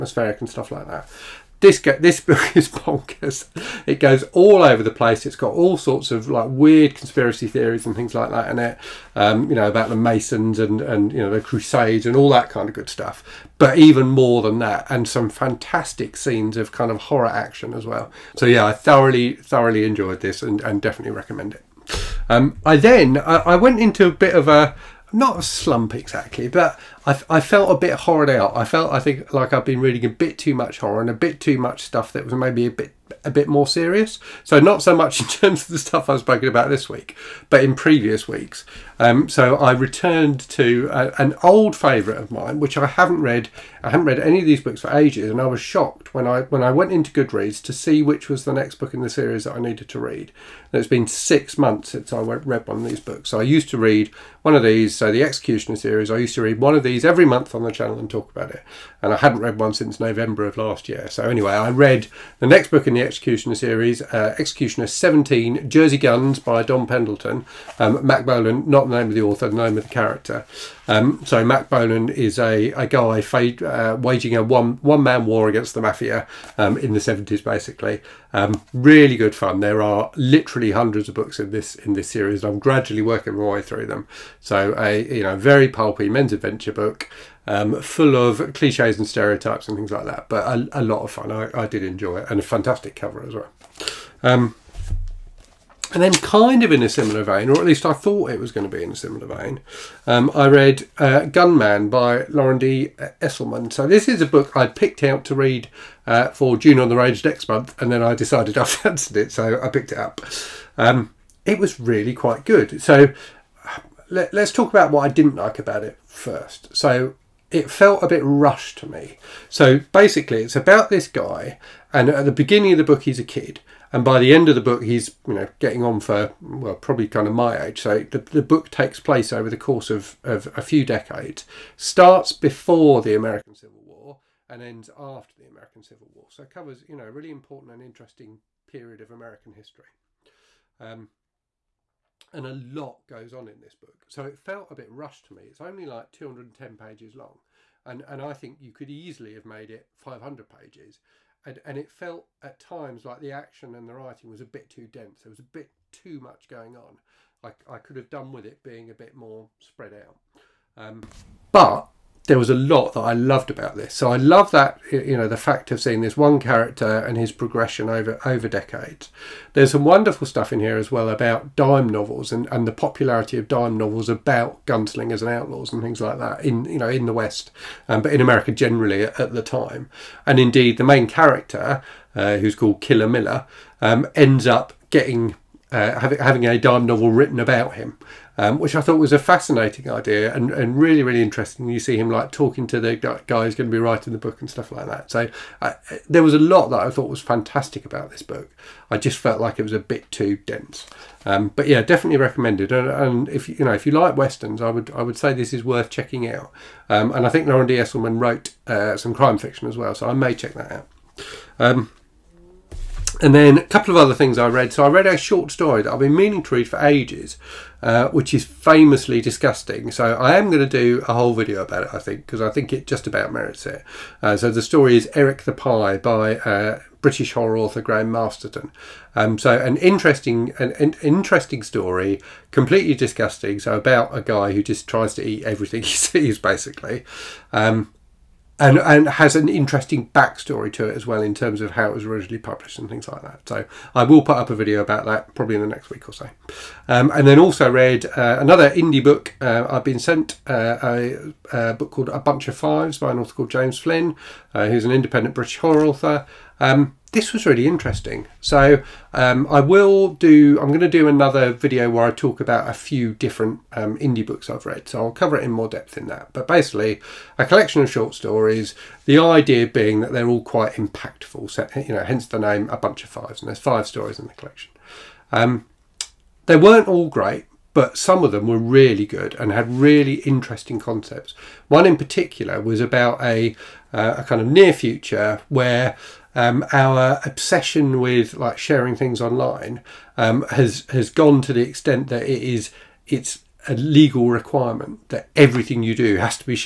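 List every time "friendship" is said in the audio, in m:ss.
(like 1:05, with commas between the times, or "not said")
not said.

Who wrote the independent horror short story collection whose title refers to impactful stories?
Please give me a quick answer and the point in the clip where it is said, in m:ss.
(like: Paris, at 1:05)
James Flynn, at 4:13.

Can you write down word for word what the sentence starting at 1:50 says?
Um, it was really quite good.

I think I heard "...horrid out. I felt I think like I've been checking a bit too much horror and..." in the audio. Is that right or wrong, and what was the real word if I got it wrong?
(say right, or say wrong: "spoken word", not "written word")
wrong: "reading", not "checking".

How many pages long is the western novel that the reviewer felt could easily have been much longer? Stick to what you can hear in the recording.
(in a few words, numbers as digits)
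210.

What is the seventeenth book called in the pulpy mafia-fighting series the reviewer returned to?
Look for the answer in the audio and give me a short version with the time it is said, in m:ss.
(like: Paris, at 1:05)
Jersey Guns, at 1:05.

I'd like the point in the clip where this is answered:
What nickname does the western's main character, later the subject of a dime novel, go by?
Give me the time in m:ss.
3:02.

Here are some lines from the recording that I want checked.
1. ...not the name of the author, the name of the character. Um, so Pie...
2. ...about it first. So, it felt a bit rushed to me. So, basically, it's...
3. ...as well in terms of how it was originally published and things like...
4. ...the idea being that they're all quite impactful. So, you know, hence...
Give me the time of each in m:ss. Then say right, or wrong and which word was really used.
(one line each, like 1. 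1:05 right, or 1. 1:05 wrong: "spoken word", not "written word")
1. 1:08 wrong: "Mack", not "Pie"
2. 1:55 right
3. 4:00 right
4. 4:29 right.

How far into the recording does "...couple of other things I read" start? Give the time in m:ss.
3:33.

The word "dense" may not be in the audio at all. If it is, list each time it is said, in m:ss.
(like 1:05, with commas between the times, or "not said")
2:34, 3:20.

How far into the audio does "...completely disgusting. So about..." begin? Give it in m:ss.
3:52.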